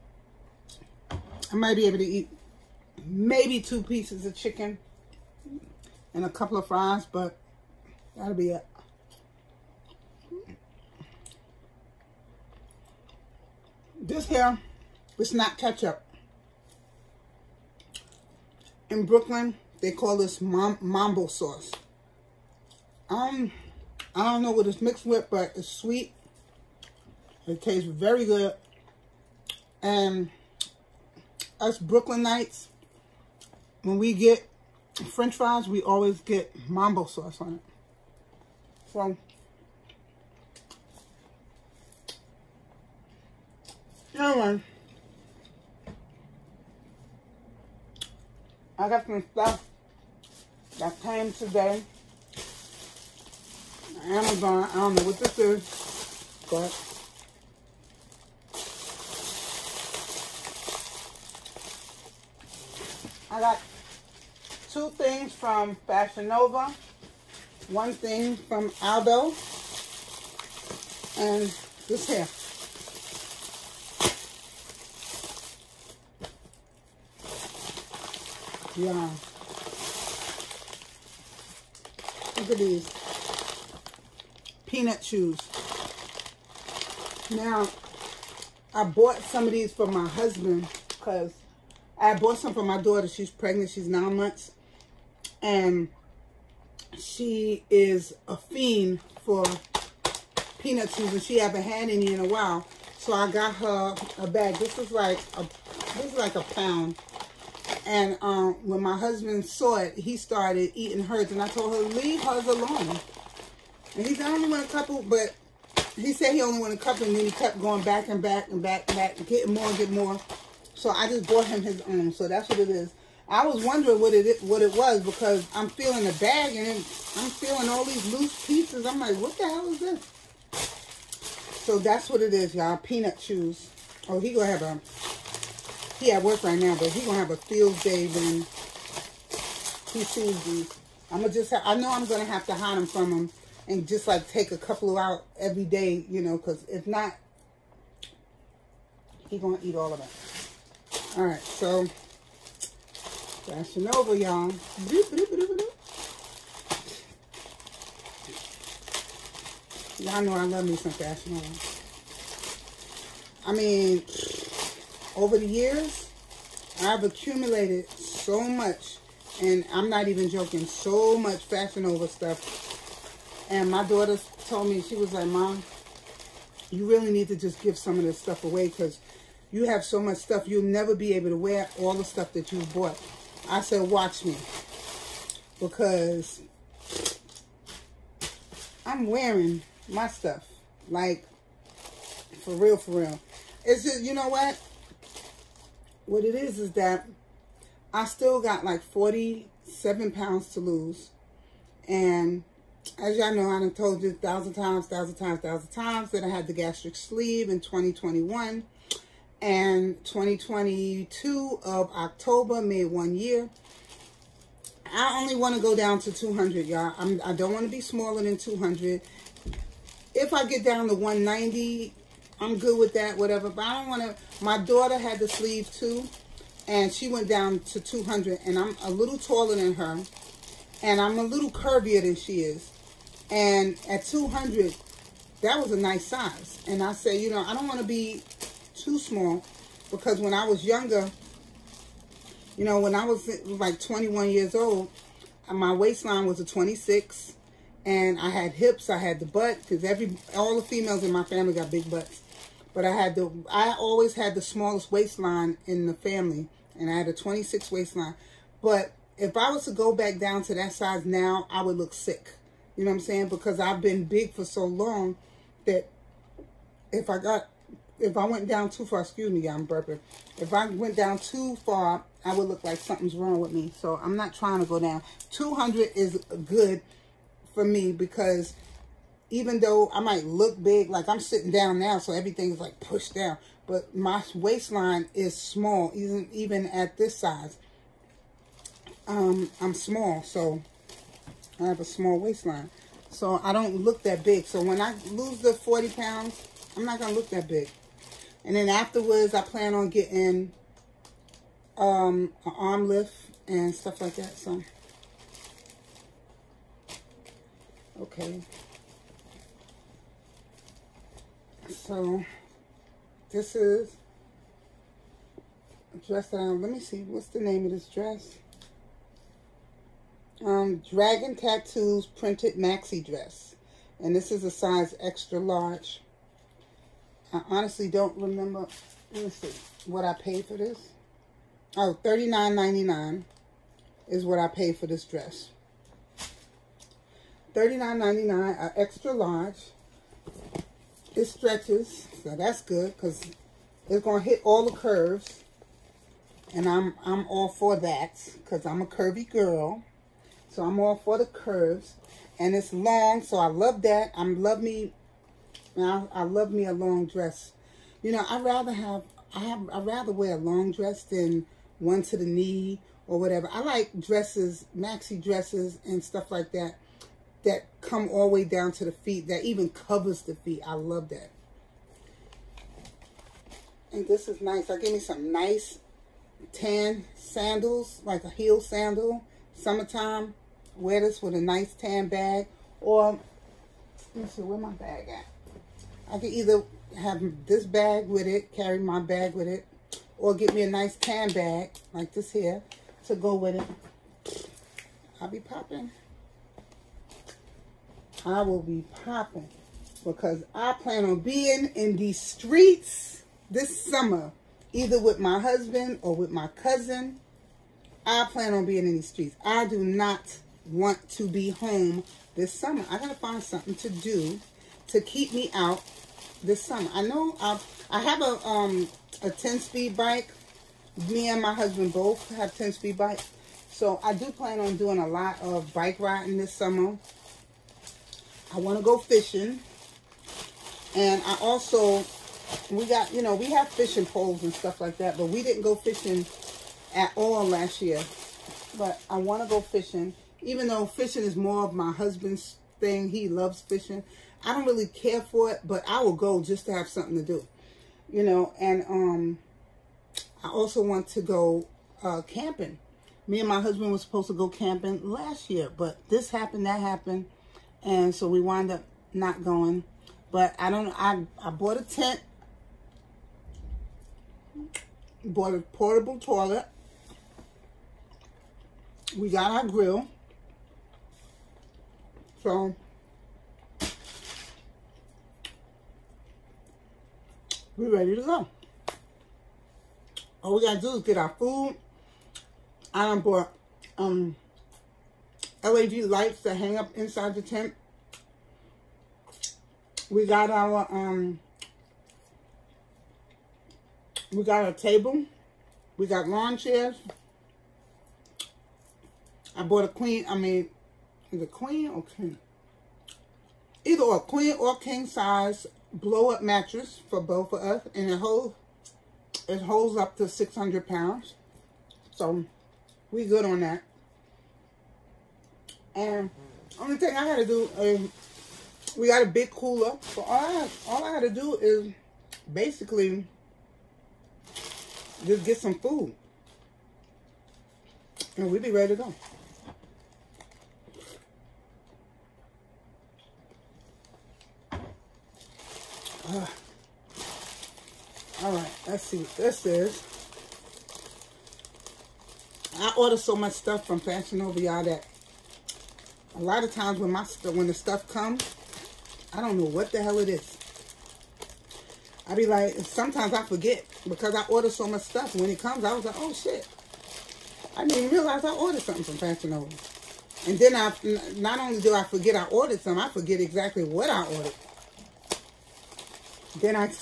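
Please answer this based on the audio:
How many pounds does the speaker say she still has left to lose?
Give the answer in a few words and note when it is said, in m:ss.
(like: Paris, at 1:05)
47, at 3:18.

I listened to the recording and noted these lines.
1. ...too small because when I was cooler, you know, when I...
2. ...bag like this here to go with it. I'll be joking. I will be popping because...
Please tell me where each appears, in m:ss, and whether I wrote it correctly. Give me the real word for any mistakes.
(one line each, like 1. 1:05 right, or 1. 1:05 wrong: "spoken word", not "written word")
1. 3:58 wrong: "younger", not "cooler"
2. 6:31 wrong: "popping", not "joking".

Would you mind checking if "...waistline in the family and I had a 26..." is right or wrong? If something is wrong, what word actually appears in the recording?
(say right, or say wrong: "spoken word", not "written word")
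right.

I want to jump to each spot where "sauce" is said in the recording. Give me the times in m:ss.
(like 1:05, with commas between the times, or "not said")
0:21, 0:37.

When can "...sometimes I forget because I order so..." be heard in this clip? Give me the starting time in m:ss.
9:12.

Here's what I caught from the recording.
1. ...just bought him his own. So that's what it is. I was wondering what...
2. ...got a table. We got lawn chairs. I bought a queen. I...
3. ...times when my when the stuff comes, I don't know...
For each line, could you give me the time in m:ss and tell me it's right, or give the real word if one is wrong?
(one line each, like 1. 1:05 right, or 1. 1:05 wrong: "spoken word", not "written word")
1. 2:01 right
2. 8:14 right
3. 9:06 right.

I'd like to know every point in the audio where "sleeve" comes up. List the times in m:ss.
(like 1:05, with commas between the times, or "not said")
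3:26, 3:45.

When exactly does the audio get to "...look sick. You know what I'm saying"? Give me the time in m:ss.
4:21.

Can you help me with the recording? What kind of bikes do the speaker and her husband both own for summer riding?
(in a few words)
10-speed bikes.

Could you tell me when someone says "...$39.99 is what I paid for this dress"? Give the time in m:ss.
5:32.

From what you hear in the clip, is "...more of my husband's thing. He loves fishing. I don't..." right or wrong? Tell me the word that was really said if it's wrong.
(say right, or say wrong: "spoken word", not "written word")
right.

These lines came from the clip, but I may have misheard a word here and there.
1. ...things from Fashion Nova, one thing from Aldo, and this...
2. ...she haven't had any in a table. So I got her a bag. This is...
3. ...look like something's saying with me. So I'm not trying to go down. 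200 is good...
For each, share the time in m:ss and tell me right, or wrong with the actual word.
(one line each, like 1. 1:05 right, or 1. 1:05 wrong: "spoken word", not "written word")
1. 1:04 right
2. 1:41 wrong: "while", not "table"
3. 4:32 wrong: "wrong", not "saying".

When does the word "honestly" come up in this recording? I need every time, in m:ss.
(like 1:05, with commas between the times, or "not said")
5:27.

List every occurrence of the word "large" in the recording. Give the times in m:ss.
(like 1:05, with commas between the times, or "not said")
5:25, 5:39.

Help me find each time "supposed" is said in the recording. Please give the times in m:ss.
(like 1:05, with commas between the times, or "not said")
7:33.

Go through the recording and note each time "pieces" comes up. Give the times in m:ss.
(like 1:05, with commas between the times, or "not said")
0:03, 2:08.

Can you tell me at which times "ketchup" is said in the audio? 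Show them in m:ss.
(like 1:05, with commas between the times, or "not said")
0:15.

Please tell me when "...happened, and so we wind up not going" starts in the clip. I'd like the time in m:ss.
7:36.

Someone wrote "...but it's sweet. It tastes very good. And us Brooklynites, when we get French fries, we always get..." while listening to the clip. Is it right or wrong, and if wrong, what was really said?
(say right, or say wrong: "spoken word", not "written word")
right.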